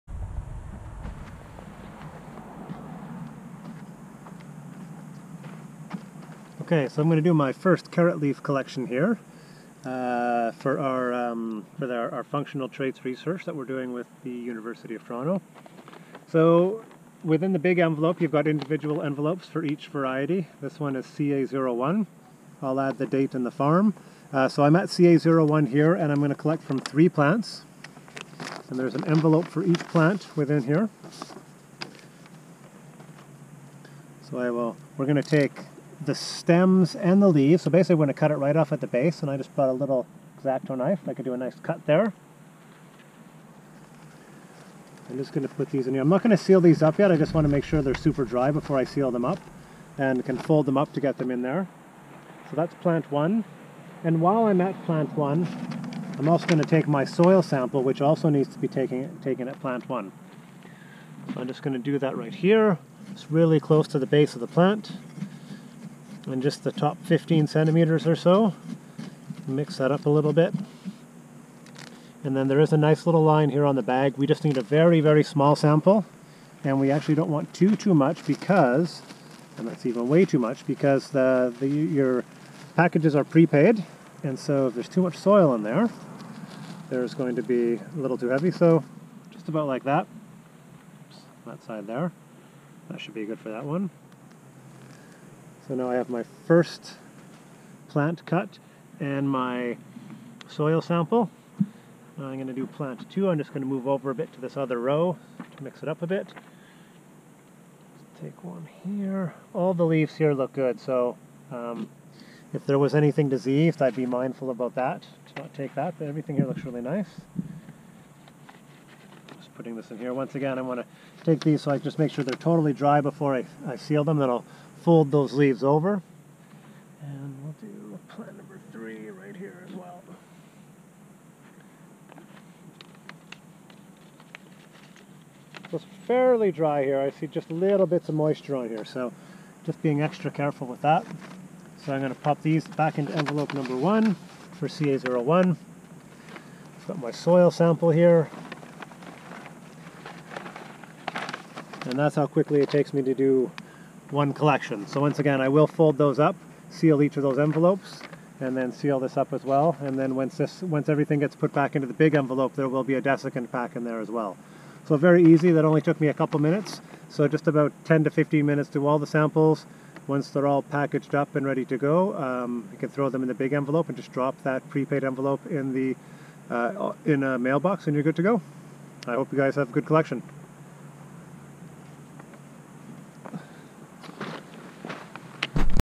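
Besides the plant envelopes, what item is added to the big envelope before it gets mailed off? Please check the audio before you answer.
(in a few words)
desiccant pack.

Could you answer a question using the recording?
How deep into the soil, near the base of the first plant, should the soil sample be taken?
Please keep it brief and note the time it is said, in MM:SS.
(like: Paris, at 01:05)
15 centimeters, at 01:07.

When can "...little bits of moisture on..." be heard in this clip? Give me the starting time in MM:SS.
02:17.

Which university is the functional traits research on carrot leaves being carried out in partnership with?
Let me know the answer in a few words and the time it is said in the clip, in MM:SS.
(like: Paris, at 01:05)
University of Toronto, at 00:14.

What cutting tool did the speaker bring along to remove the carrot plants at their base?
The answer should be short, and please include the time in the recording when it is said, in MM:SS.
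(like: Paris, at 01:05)
X-Acto knife, at 00:40.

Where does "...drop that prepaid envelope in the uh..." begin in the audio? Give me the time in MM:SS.
02:54.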